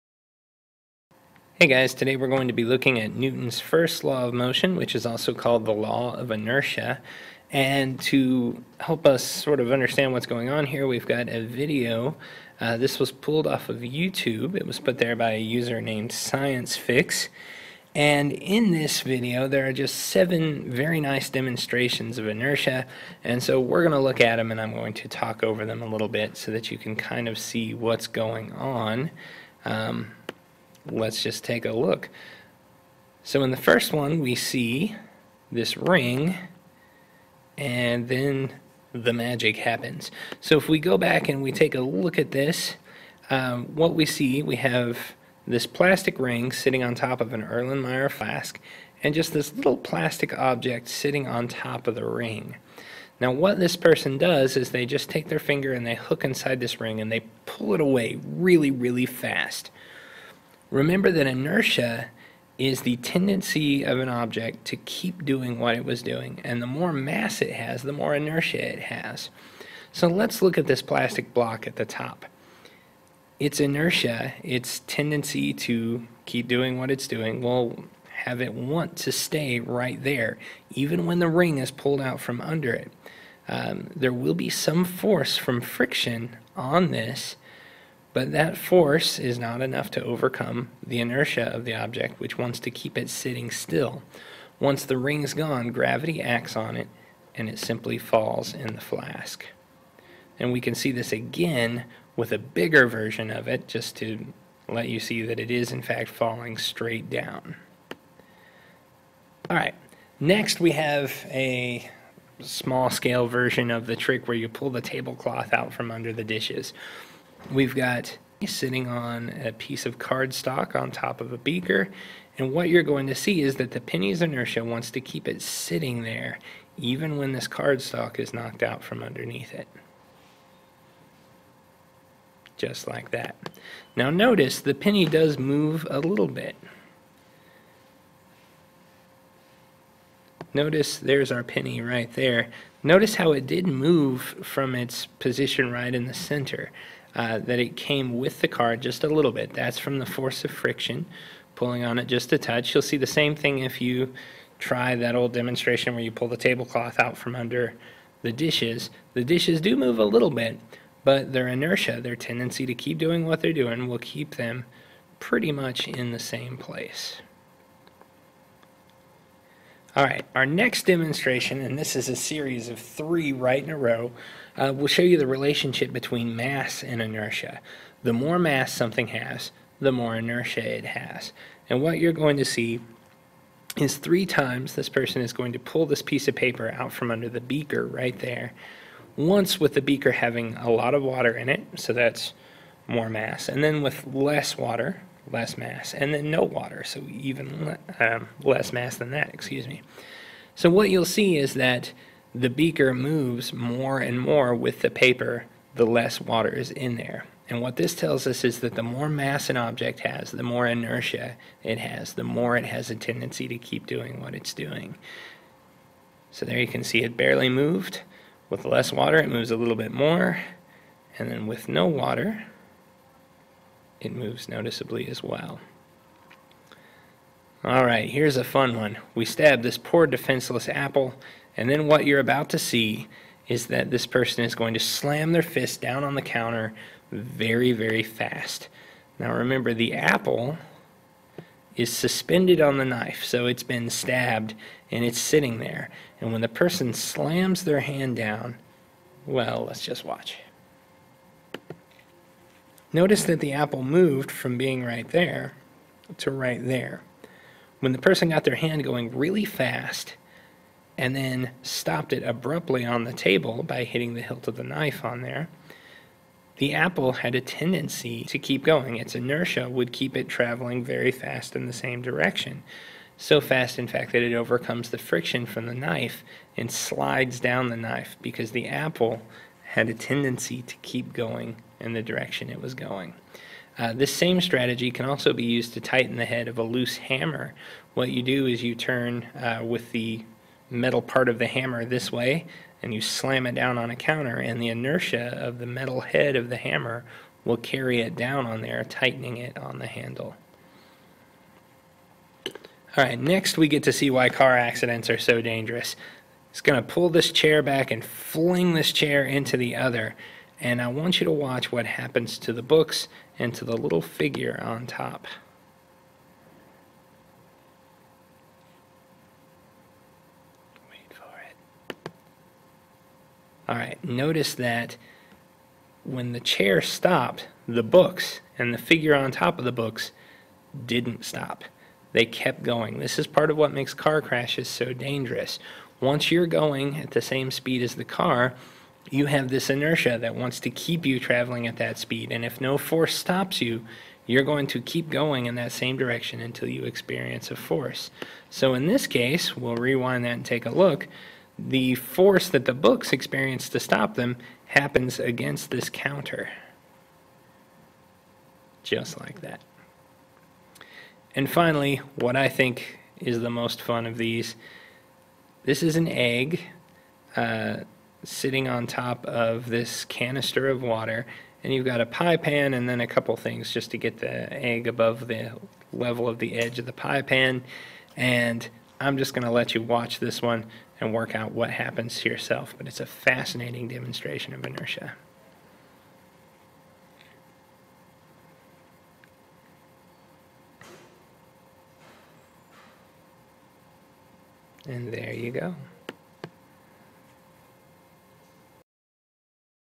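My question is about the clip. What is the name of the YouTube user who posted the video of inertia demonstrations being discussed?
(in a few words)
ScienceFix.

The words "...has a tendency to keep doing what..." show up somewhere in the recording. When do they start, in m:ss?
3:32.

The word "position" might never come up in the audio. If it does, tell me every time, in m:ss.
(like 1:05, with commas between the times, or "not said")
2:25.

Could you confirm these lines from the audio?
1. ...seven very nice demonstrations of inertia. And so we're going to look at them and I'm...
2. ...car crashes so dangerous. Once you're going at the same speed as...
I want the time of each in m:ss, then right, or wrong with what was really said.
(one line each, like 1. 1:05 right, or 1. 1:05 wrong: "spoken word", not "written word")
1. 0:19 right
2. 5:33 right.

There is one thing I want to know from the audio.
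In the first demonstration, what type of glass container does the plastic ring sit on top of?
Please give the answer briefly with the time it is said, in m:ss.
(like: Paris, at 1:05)
Erlenmeyer flask, at 0:47.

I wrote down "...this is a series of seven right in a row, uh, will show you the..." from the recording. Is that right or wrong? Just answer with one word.
wrong.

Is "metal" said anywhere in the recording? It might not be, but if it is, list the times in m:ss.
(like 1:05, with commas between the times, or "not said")
4:50, 4:55.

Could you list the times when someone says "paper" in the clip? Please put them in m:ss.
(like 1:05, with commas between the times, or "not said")
3:06, 3:24.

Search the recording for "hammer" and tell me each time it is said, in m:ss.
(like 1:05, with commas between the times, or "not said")
4:46, 4:51, 4:56.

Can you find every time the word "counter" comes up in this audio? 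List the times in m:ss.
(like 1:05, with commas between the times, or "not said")
3:56, 4:53, 5:55.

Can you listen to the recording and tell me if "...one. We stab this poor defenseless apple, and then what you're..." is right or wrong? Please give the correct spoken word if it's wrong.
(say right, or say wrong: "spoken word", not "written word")
right.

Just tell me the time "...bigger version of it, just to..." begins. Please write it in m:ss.
1:42.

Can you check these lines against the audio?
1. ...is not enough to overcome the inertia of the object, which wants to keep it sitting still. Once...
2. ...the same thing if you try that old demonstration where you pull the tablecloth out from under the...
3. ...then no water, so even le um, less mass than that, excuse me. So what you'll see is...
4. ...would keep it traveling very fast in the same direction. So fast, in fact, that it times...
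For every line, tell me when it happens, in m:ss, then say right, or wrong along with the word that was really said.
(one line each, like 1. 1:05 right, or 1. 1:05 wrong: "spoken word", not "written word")
1. 1:29 right
2. 2:32 right
3. 3:16 right
4. 4:29 wrong: "overcomes", not "times".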